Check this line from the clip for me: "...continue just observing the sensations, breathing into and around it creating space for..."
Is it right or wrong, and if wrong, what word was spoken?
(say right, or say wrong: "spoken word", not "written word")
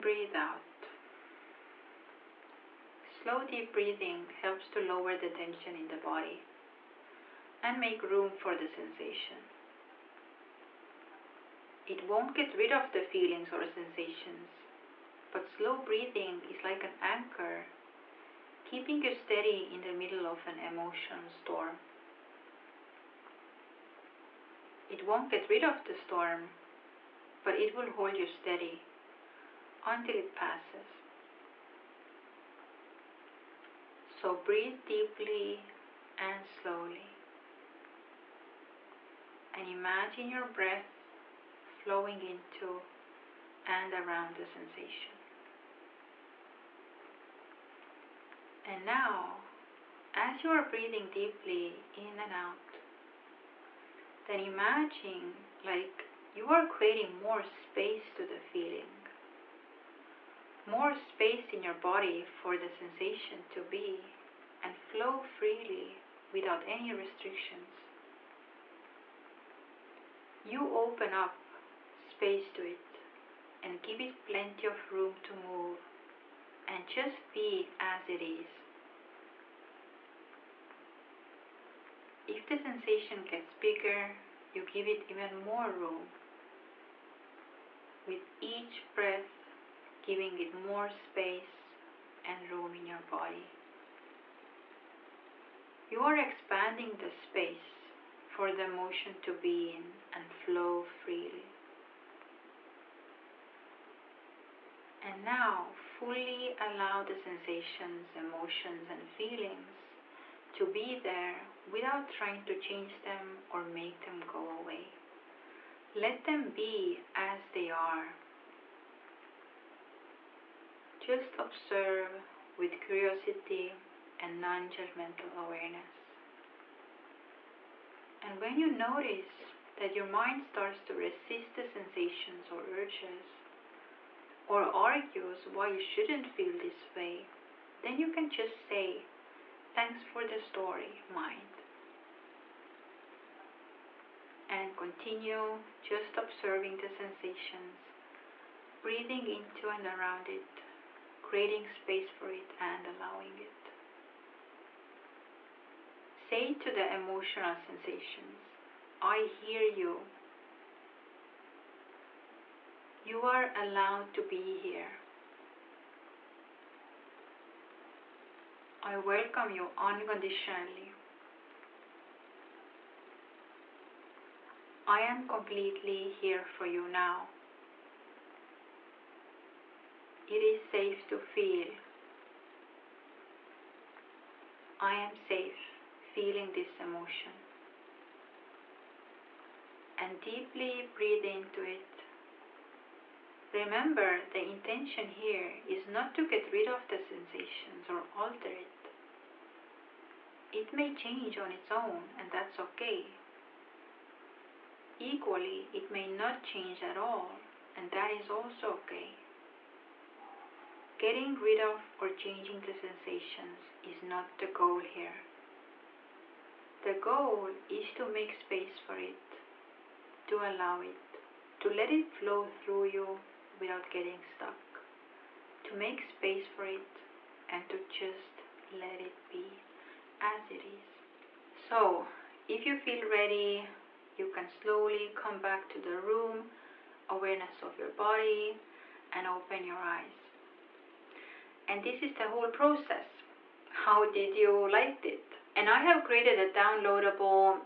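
right.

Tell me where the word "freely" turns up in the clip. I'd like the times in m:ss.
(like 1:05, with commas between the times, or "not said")
1:05, 1:41.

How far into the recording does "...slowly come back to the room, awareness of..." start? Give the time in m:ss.
3:54.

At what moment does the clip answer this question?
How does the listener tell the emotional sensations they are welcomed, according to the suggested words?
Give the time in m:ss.
2:49.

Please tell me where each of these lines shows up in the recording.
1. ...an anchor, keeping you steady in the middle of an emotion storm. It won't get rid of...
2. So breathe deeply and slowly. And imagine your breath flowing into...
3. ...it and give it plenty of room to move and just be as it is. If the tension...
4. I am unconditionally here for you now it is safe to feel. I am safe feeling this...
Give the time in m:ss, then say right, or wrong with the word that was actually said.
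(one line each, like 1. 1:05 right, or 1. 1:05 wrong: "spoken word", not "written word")
1. 0:16 right
2. 0:34 right
3. 1:12 wrong: "sensation", not "tension"
4. 2:54 wrong: "completely", not "unconditionally".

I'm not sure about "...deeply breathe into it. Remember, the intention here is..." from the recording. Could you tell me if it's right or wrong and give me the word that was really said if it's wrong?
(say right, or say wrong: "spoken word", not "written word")
right.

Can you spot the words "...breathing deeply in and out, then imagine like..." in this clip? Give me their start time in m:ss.
0:50.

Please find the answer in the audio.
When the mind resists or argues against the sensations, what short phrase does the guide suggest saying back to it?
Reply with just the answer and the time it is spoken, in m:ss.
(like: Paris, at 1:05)
Thanks for the story, at 2:19.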